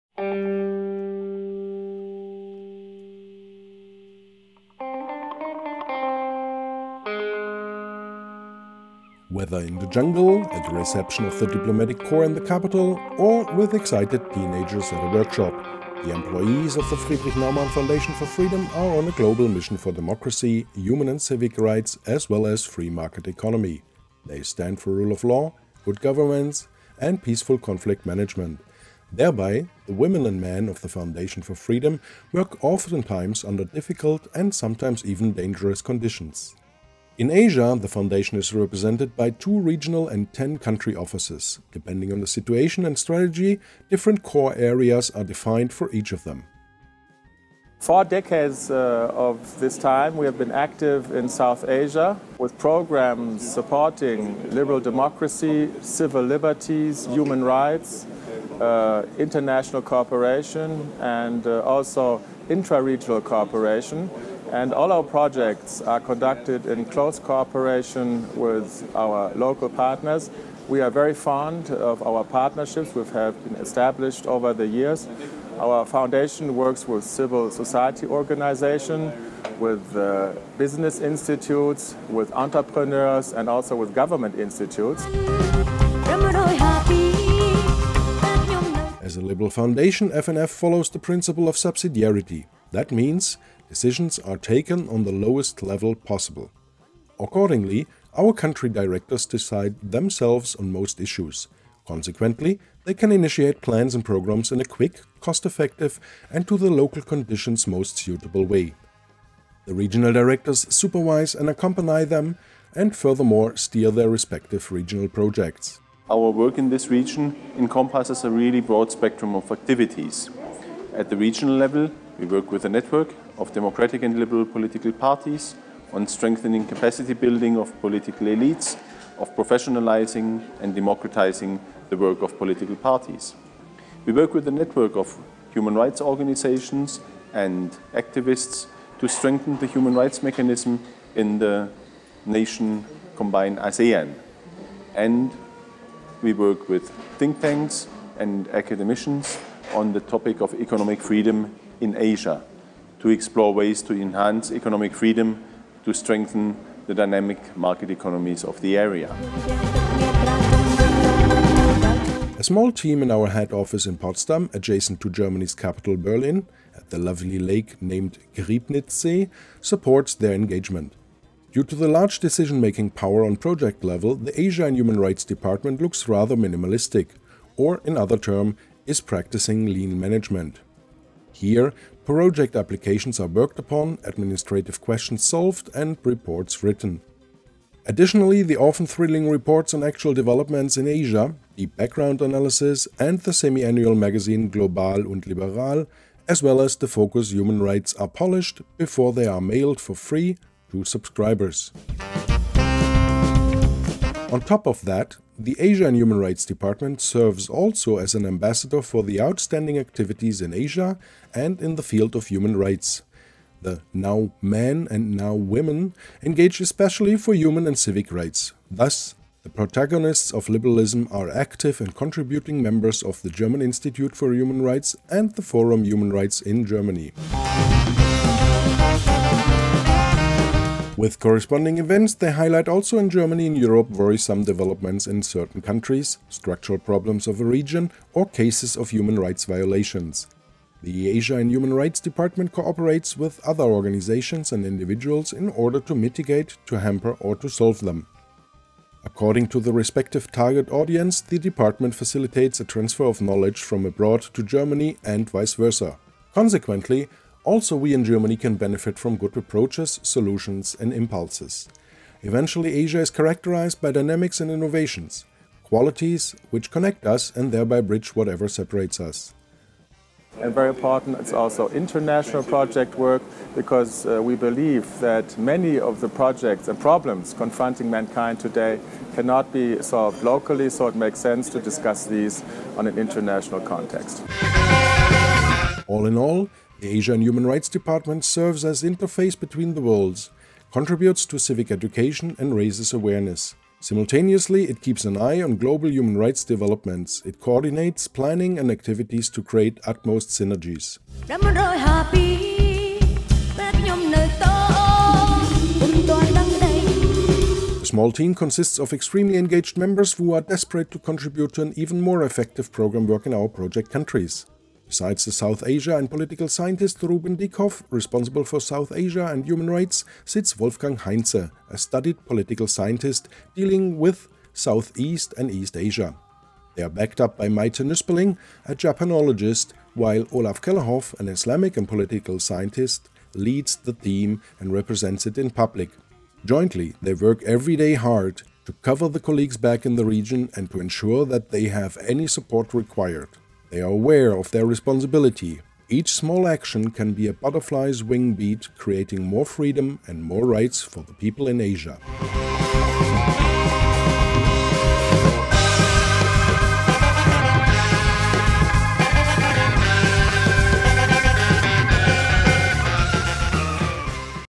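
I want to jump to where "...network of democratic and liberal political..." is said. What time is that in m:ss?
2:02.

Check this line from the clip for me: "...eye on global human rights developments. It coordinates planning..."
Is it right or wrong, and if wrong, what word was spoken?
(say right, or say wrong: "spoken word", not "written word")
right.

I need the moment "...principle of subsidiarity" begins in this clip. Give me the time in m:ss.
1:30.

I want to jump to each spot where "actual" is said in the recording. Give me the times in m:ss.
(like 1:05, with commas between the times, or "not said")
3:09.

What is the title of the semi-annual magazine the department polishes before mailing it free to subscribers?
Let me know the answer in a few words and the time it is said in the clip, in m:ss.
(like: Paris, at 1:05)
Global und Liberal, at 3:14.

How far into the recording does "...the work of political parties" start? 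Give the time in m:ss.
2:11.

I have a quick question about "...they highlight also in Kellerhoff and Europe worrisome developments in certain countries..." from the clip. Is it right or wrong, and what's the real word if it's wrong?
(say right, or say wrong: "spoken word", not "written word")
wrong: "Germany", not "Kellerhoff".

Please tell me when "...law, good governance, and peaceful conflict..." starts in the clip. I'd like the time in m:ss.
0:25.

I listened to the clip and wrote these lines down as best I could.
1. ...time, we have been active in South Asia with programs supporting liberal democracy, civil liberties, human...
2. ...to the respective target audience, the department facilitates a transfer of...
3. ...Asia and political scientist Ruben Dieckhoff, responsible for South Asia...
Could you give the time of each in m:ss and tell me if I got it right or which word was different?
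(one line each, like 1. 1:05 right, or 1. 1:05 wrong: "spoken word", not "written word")
1. 0:49 right
2. 4:09 right
3. 5:15 right.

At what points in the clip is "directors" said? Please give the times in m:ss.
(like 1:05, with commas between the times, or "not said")
1:38, 1:50.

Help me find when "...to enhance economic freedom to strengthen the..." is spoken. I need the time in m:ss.
2:33.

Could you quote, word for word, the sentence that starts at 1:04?
And all our projects are conducted in close cooperation with our local partners.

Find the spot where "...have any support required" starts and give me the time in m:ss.
5:41.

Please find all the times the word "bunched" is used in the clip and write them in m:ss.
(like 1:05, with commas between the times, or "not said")
not said.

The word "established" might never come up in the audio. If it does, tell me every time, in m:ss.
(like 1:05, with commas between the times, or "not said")
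1:13.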